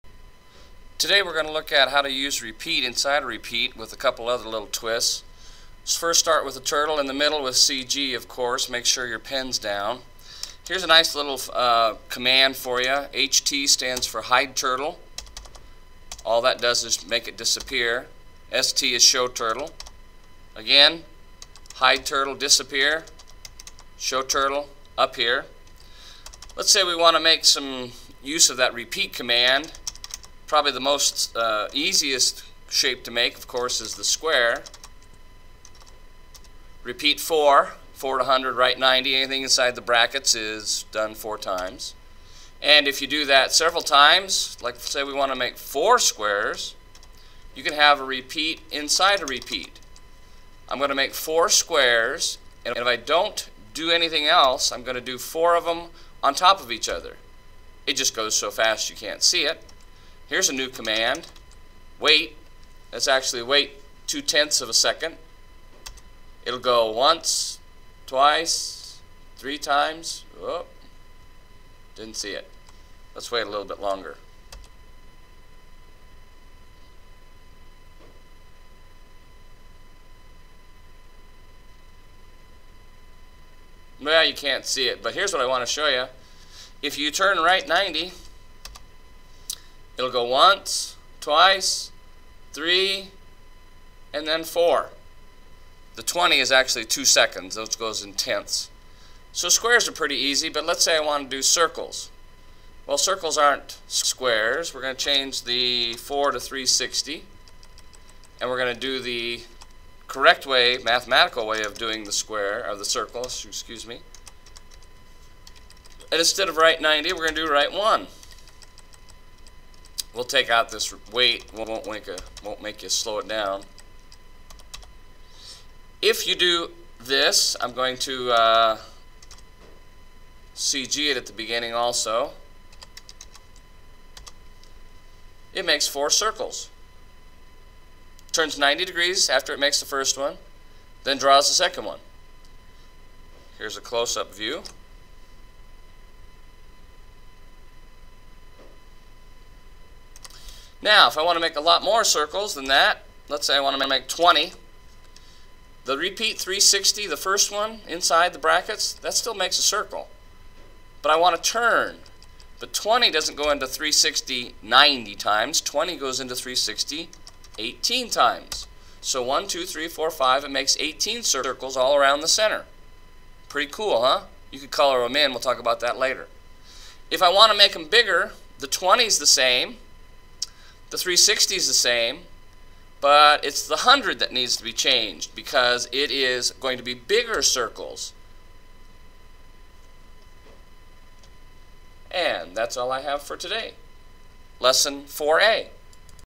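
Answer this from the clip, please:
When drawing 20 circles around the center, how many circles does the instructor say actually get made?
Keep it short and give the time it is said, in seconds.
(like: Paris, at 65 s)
18, at 170 s.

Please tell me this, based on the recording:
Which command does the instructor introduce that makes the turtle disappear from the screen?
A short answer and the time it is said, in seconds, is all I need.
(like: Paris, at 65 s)
HT, at 13 s.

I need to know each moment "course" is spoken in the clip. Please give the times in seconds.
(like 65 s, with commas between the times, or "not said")
8 s, 33 s.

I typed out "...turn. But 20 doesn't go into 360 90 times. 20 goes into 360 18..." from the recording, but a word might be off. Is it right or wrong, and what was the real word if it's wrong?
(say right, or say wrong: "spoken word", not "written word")
right.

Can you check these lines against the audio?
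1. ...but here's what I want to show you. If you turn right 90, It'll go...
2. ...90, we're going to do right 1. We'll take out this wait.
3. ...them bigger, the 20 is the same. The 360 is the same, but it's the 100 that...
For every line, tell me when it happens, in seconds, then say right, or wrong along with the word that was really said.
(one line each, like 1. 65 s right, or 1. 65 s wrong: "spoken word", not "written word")
1. 85 s right
2. 116 s right
3. 177 s right.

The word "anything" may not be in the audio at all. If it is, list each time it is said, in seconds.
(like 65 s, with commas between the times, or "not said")
39 s, 53 s.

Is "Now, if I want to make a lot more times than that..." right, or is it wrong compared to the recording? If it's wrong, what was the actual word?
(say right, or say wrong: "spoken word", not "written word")
wrong: "circles", not "times".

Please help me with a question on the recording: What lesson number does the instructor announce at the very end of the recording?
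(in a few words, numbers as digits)
4A.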